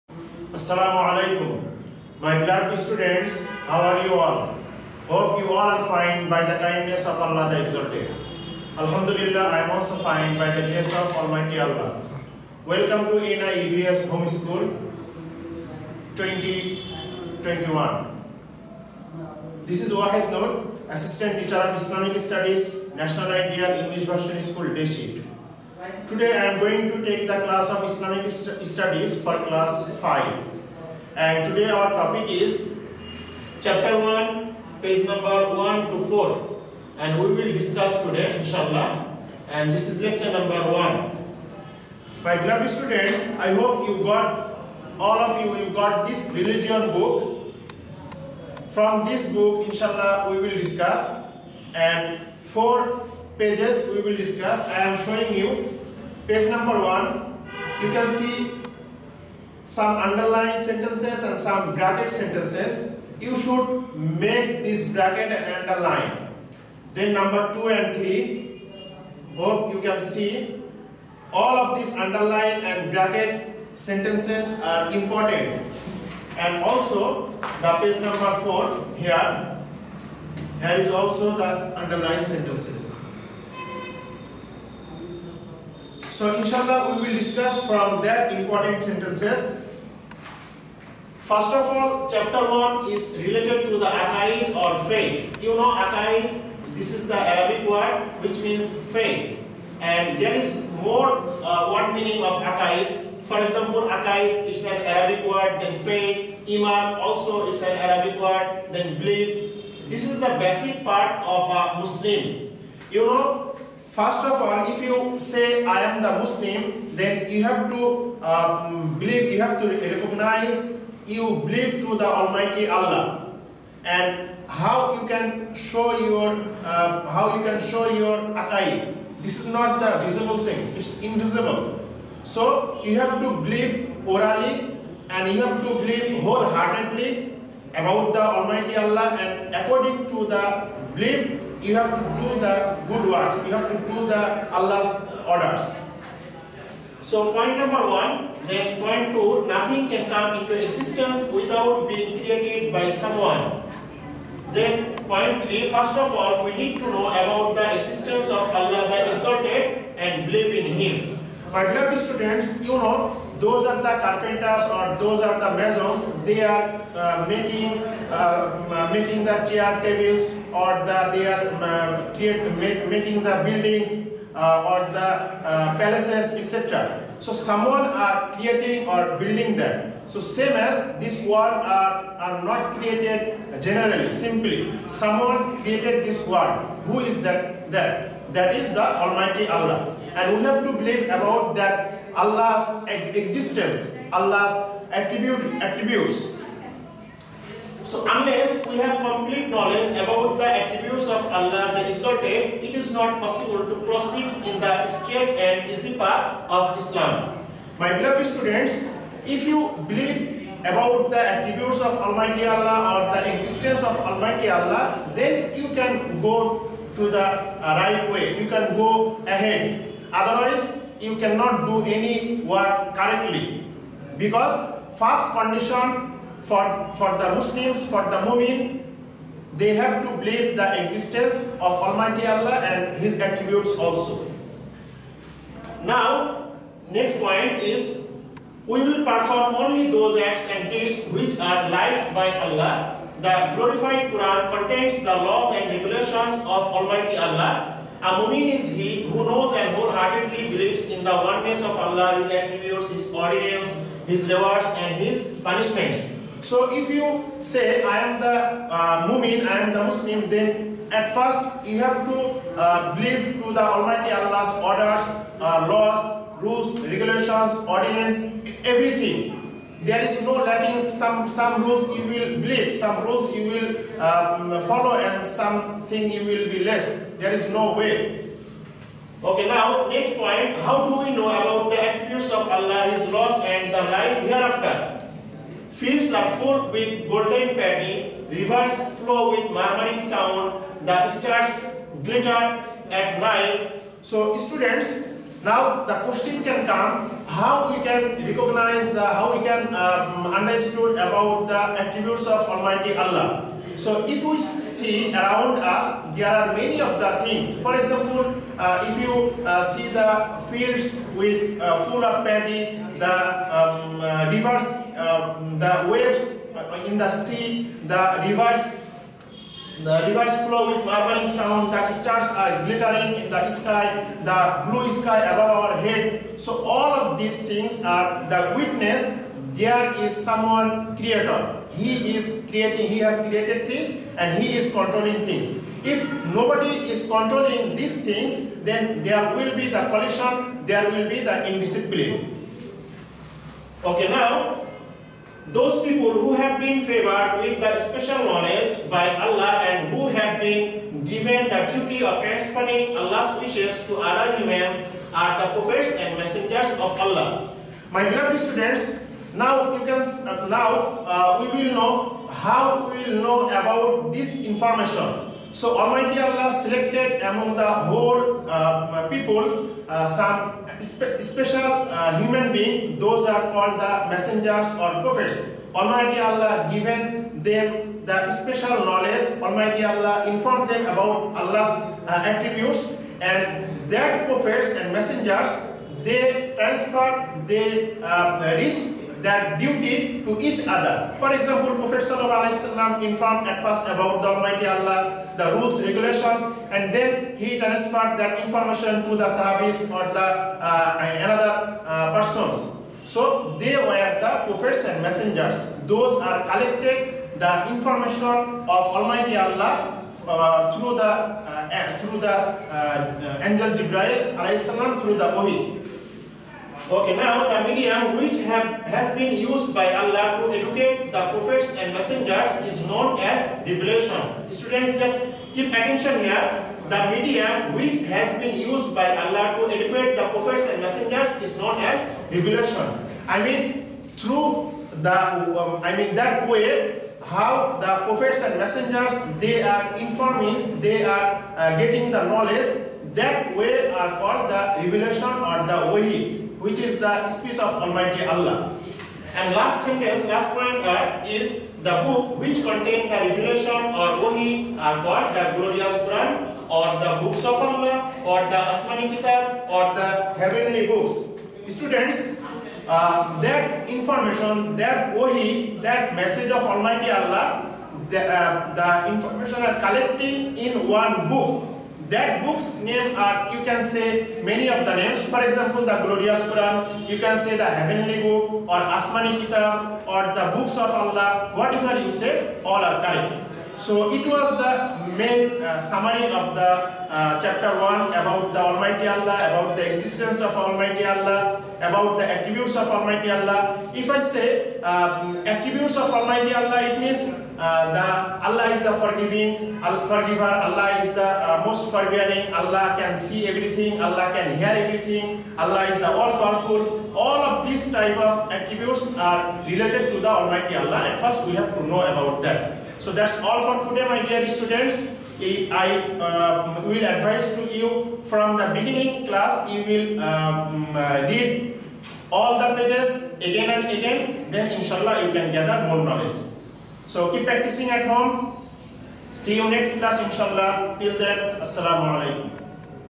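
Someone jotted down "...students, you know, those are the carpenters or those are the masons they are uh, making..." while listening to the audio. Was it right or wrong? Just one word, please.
right.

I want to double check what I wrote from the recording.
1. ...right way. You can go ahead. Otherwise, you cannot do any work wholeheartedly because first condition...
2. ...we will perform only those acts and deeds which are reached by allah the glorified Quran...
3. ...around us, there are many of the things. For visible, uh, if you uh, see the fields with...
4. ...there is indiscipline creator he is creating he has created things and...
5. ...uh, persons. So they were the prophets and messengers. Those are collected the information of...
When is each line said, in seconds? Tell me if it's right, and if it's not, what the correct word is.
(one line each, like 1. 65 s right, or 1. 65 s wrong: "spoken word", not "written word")
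1. 217 s wrong: "correctly", not "wholeheartedly"
2. 238 s wrong: "liked", not "reached"
3. 305 s wrong: "example", not "visible"
4. 329 s wrong: "someone", not "indiscipline"
5. 401 s right.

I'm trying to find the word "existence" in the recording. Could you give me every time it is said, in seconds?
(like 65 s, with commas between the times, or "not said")
150 s, 157 s, 193 s, 213 s, 230 s, 489 s.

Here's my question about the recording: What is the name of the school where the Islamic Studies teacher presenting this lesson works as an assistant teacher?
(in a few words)
National Ideal English Version School.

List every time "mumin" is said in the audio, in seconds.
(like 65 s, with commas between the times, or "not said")
228 s, 259 s.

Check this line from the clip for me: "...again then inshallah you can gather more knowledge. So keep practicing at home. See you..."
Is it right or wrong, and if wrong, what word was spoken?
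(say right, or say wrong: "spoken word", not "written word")
right.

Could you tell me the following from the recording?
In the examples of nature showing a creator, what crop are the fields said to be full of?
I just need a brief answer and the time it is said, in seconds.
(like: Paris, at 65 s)
golden paddy, at 287 s.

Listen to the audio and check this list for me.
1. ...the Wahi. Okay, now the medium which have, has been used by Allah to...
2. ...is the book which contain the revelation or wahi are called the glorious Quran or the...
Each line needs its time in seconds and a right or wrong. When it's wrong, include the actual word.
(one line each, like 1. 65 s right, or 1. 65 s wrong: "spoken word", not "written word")
1. 415 s right
2. 451 s right.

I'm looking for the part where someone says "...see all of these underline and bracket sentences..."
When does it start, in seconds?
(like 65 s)
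70 s.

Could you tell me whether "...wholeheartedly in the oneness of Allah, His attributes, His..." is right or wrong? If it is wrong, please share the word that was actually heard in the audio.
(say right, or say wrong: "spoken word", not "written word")
right.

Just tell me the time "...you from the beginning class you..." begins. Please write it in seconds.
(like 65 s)
517 s.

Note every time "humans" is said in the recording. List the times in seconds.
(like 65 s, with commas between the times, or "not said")
354 s, 372 s.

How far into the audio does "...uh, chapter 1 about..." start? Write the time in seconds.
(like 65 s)
486 s.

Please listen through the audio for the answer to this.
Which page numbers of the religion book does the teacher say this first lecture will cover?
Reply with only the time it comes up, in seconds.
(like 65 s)
34 s.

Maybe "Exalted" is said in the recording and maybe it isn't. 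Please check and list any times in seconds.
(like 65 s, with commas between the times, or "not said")
7 s, 159 s, 201 s.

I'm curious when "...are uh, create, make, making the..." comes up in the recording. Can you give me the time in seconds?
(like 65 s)
171 s.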